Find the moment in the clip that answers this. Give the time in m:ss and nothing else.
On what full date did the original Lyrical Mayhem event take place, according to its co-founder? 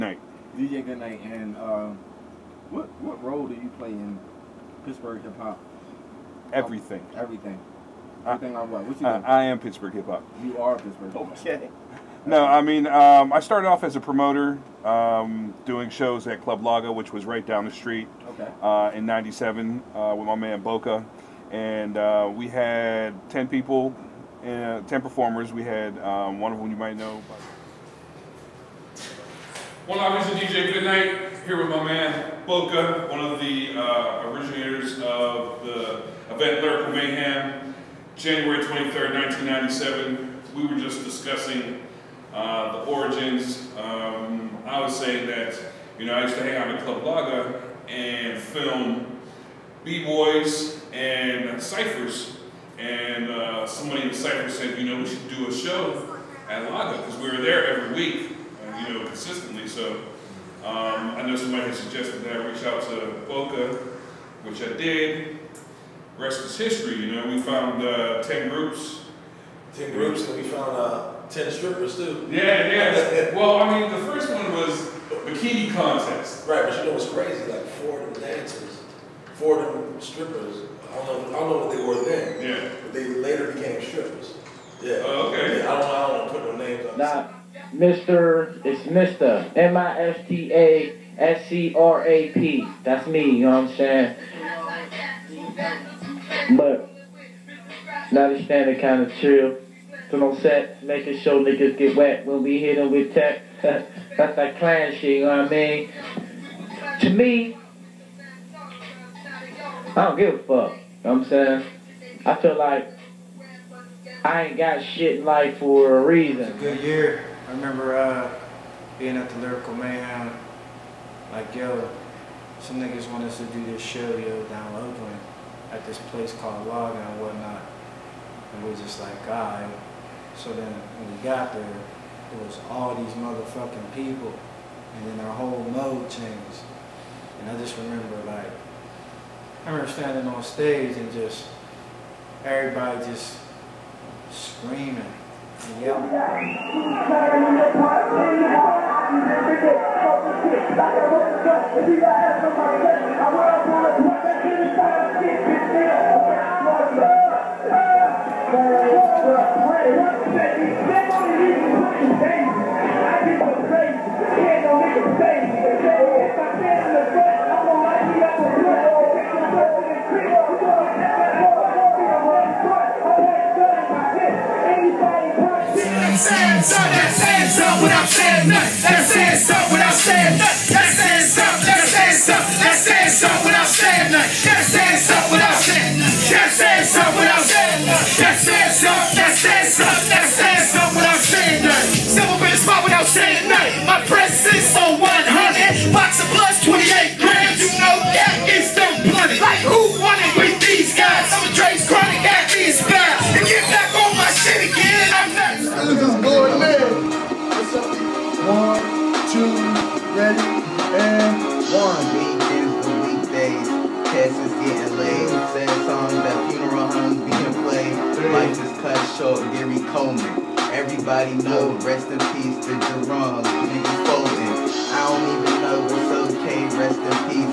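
0:38.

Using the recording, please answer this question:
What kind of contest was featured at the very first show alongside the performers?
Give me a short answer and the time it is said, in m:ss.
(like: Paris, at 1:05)
Bikini contest, at 1:15.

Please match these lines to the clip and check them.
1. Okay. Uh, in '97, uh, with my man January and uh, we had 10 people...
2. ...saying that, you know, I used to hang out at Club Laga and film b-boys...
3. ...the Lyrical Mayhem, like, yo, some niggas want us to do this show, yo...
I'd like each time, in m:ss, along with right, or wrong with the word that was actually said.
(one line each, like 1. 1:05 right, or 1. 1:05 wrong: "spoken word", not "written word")
1. 0:18 wrong: "Boca", not "January"
2. 0:44 right
3. 1:59 right.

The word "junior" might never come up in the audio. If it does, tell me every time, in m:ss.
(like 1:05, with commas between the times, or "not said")
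not said.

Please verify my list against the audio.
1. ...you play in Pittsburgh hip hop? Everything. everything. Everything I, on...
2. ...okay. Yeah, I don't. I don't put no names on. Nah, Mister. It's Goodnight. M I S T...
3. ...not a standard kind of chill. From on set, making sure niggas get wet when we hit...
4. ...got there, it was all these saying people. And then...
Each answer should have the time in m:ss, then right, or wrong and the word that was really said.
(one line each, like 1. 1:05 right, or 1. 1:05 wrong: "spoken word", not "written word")
1. 0:03 right
2. 1:25 wrong: "Mister", not "Goodnight"
3. 1:38 right
4. 2:11 wrong: "motherfucking", not "saying".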